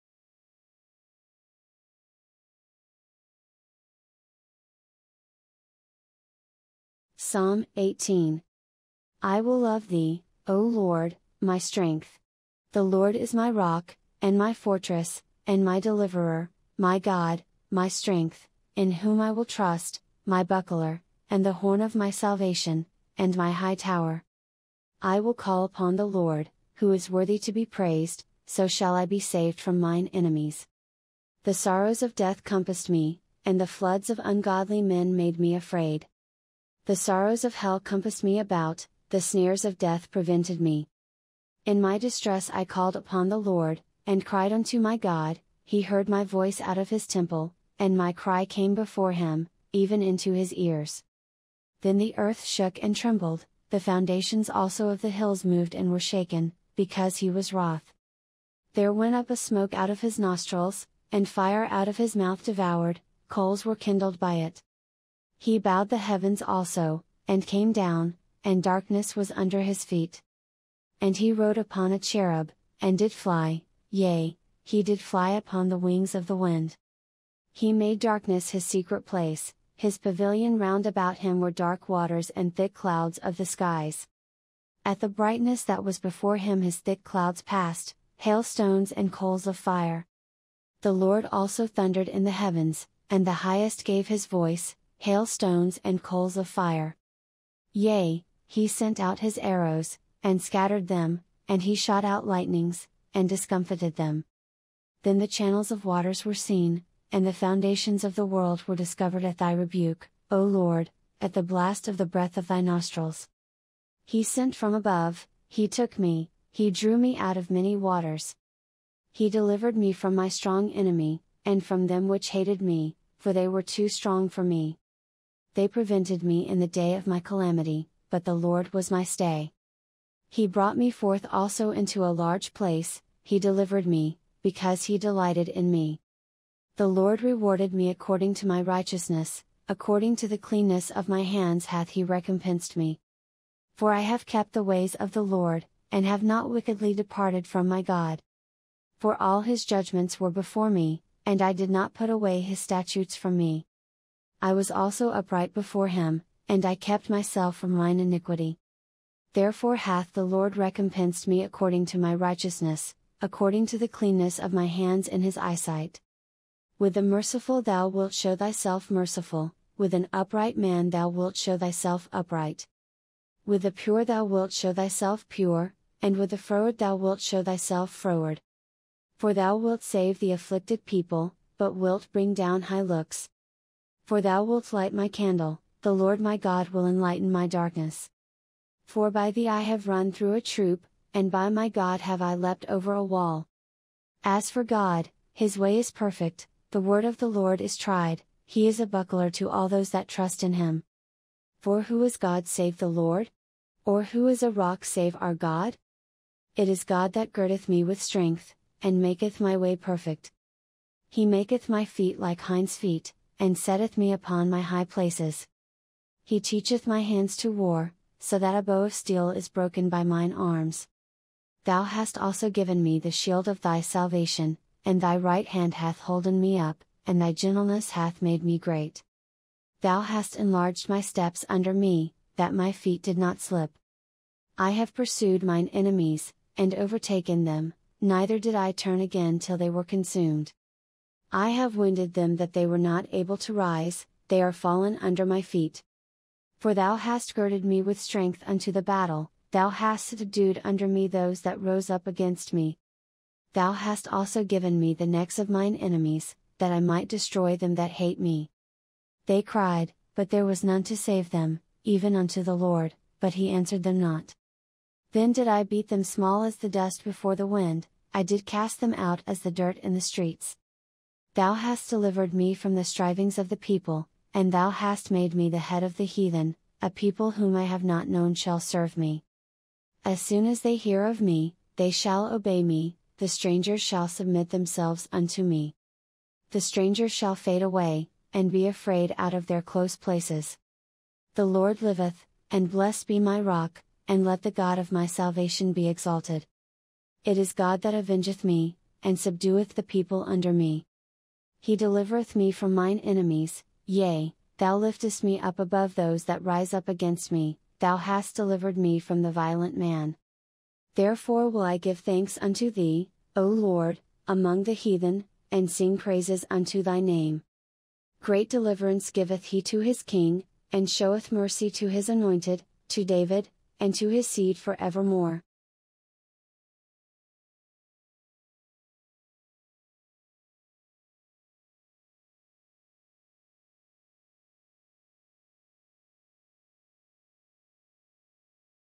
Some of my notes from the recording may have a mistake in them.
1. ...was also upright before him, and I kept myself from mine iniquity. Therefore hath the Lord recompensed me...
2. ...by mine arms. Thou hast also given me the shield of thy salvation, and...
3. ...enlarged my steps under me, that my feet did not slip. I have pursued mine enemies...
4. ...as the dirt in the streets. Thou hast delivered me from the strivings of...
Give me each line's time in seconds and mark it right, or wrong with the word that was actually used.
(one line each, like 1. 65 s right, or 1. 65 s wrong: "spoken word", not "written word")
1. 154 s right
2. 219 s right
3. 230 s right
4. 269 s right.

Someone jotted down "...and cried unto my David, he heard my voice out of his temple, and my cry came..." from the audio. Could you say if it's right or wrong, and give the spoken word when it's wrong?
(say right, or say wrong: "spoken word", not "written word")
wrong: "God", not "David".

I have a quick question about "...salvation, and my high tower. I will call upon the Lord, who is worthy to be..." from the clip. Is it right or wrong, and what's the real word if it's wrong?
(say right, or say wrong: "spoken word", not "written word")
right.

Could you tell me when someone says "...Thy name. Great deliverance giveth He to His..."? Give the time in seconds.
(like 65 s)
316 s.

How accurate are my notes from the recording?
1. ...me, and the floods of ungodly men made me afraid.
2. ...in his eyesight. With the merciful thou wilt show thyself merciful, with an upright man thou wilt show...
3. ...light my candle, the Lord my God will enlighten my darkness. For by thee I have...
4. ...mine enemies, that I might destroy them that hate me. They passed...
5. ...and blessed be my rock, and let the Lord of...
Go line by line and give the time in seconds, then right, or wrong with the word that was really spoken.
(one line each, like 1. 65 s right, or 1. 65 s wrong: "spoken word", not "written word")
1. 32 s right
2. 165 s right
3. 184 s right
4. 255 s wrong: "cried", not "passed"
5. 292 s wrong: "God", not "Lord".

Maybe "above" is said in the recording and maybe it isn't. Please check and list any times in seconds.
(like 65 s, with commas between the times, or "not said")
114 s, 305 s.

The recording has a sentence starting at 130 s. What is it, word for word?
He brought me forth also into a large place, He delivered me, because He delighted in me.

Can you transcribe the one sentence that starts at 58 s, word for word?
There went up a smoke out of his nostrils, and fire out of his mouth devoured, coals were kindled by it.